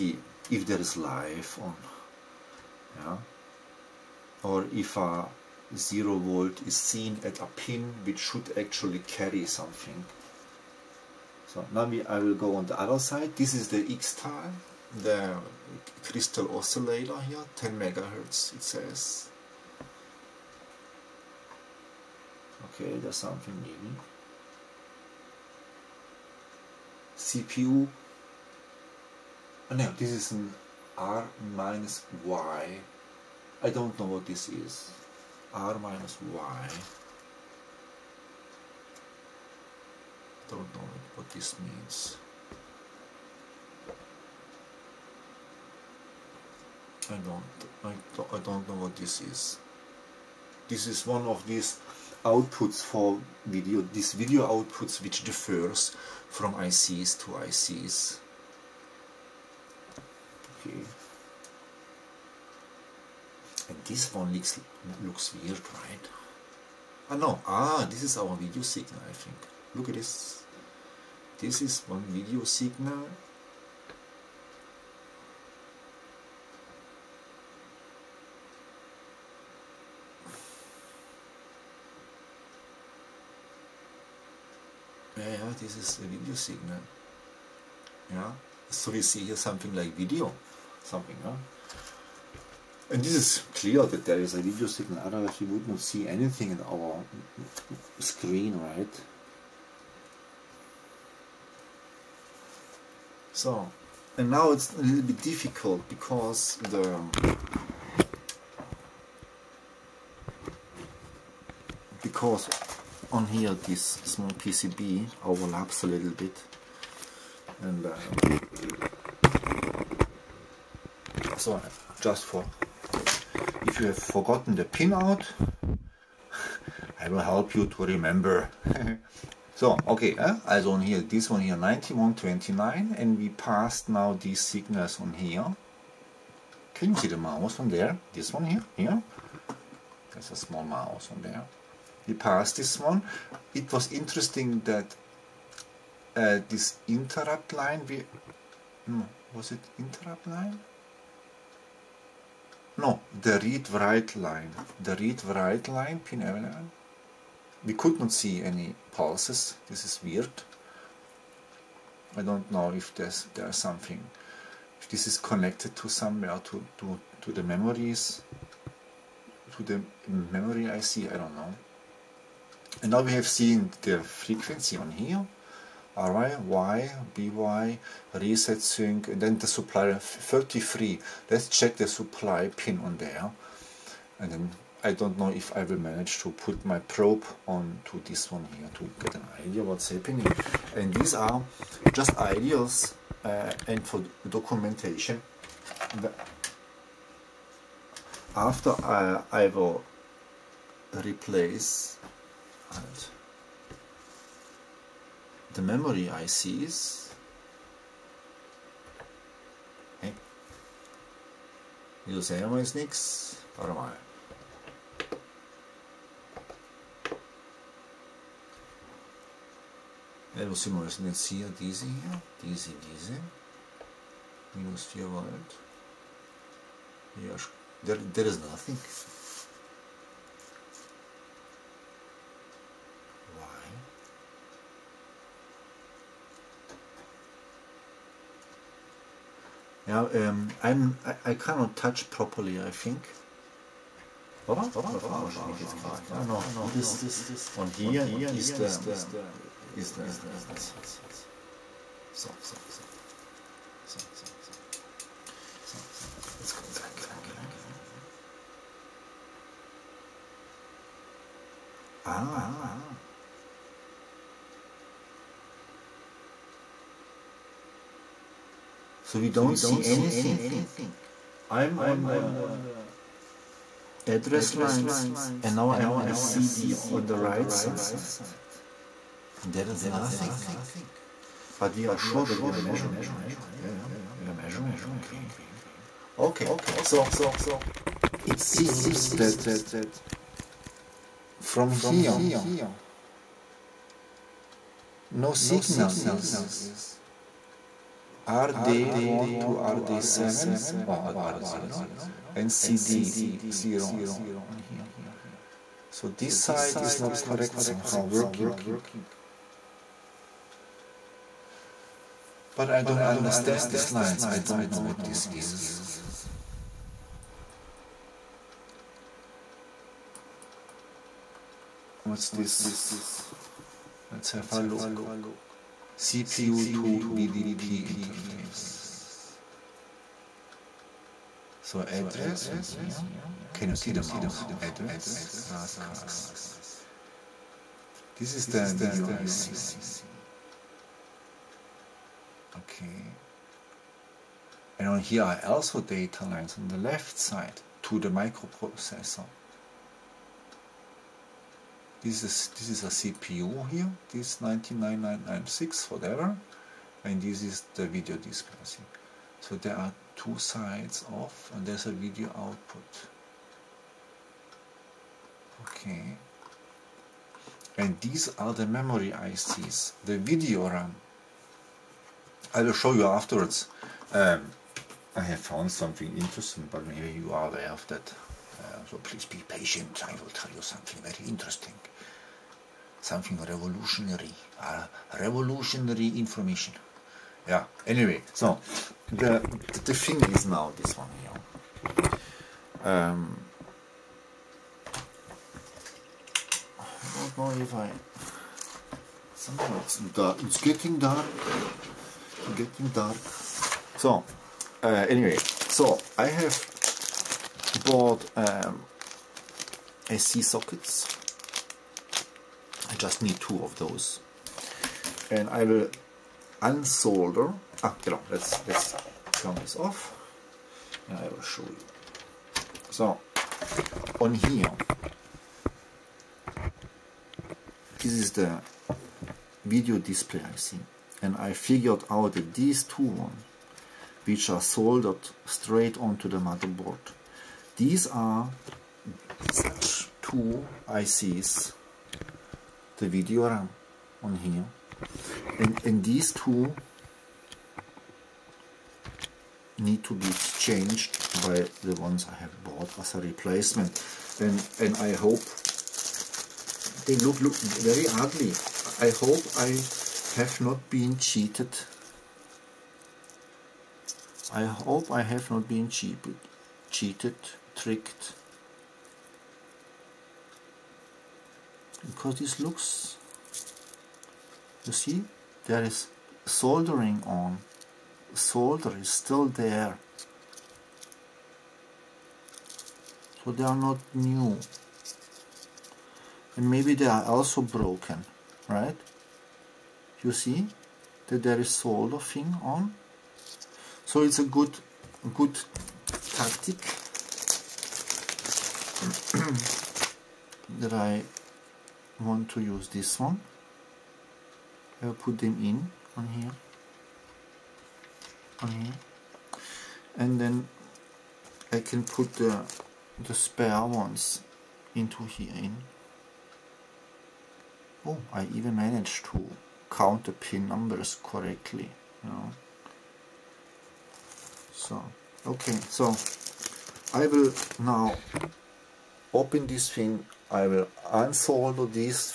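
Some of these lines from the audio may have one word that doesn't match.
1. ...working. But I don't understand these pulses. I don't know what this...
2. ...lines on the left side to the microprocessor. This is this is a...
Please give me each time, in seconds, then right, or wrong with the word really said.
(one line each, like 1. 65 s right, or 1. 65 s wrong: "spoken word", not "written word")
1. 308 s wrong: "lines", not "pulses"
2. 346 s right.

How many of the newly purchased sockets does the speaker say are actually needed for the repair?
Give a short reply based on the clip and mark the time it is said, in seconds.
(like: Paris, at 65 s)
2, at 413 s.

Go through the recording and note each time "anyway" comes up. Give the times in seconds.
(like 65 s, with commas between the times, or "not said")
387 s, 405 s.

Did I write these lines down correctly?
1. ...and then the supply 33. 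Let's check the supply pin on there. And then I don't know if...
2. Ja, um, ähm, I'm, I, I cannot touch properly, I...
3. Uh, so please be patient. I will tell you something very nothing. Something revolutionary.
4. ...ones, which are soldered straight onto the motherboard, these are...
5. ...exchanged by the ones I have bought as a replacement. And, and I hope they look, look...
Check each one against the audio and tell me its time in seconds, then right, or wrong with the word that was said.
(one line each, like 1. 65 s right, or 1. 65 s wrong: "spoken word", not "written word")
1. 179 s right
2. 239 s right
3. 378 s wrong: "interesting", not "nothing"
4. 433 s right
5. 450 s right.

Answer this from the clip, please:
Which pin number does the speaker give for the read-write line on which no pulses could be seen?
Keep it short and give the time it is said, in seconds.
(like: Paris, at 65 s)
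11, at 156 s.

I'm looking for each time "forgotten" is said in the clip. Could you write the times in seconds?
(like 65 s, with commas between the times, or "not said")
123 s.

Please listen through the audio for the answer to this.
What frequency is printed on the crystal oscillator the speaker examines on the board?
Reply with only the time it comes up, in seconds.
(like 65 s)
17 s.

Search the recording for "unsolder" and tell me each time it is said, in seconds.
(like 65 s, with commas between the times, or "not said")
416 s, 531 s.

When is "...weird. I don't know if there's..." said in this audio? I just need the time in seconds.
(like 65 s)
160 s.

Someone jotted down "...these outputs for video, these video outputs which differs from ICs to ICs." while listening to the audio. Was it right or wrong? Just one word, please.
right.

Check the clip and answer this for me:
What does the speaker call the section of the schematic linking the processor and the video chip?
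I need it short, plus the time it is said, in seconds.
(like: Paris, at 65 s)
CPU to VDP interface, at 326 s.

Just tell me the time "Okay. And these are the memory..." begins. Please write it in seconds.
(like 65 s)
365 s.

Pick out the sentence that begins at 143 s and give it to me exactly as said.
It was interesting that uh, this interrupt line, we, was it interrupt line?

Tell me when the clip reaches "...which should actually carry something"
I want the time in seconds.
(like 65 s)
8 s.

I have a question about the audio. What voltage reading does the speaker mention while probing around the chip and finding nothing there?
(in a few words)
Minus 4 volt.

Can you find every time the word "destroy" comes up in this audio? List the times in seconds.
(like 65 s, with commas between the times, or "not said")
not said.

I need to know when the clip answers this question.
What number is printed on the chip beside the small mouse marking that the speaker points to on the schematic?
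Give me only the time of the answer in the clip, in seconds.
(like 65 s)
131 s.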